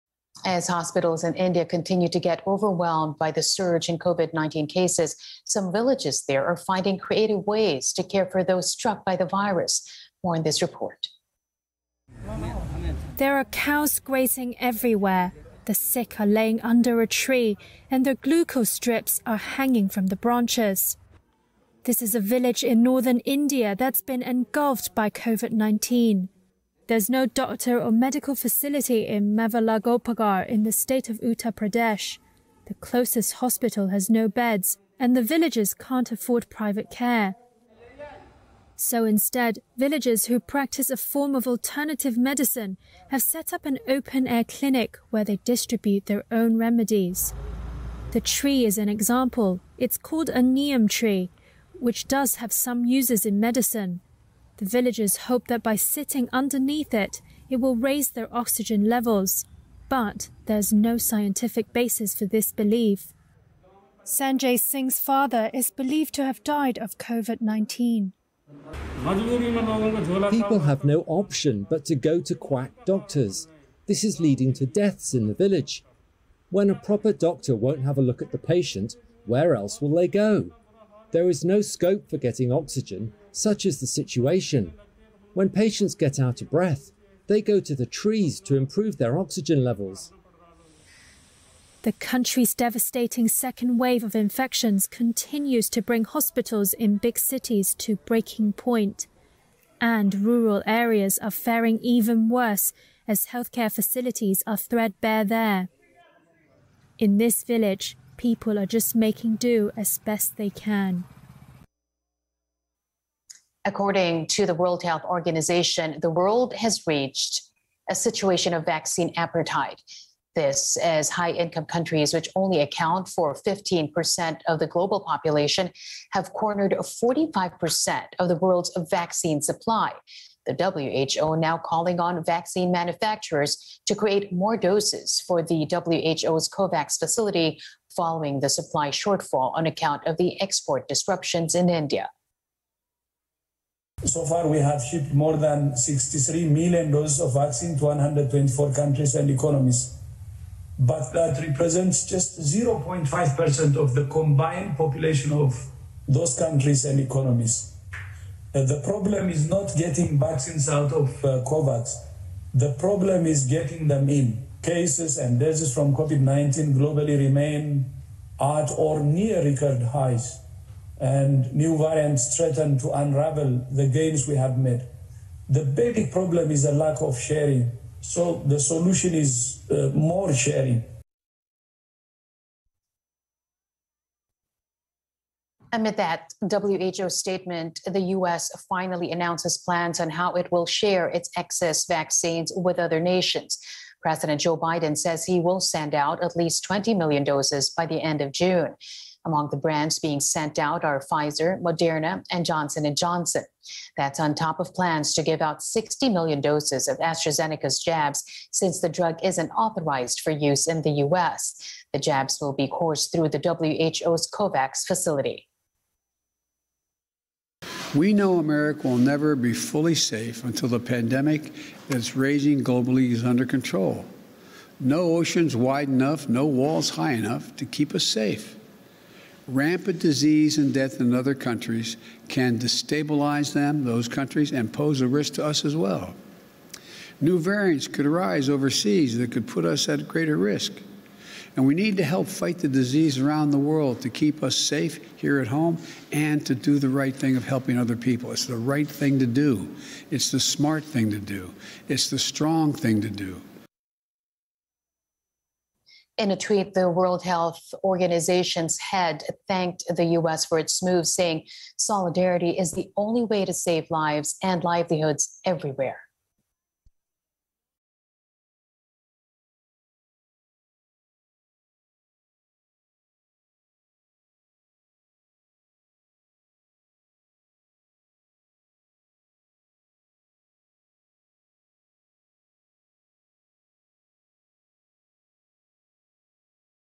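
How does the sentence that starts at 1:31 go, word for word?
The country's devastating second wave of infections continues to bring hospitals in big cities to breaking point.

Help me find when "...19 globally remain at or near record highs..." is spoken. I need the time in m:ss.
2:46.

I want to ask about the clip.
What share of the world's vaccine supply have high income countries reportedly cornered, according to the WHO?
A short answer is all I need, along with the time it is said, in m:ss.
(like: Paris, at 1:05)
45%, at 2:06.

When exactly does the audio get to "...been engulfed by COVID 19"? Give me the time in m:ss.
0:24.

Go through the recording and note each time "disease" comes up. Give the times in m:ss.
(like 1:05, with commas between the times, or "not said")
3:49, 4:02.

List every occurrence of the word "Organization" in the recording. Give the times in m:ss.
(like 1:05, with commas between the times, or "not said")
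1:55, 4:17.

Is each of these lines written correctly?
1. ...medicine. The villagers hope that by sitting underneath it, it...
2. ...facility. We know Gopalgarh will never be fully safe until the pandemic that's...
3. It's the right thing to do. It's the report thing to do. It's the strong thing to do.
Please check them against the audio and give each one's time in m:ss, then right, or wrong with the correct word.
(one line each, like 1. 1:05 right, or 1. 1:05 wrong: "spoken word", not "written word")
1. 0:53 right
2. 3:34 wrong: "America", not "Gopalgarh"
3. 4:08 wrong: "smart", not "report".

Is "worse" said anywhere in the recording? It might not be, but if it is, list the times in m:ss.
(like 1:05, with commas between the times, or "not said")
1:42.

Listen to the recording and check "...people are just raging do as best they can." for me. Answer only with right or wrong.
wrong.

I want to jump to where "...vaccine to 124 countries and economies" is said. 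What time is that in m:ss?
2:27.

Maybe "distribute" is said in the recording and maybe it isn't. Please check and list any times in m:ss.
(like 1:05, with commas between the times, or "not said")
0:45.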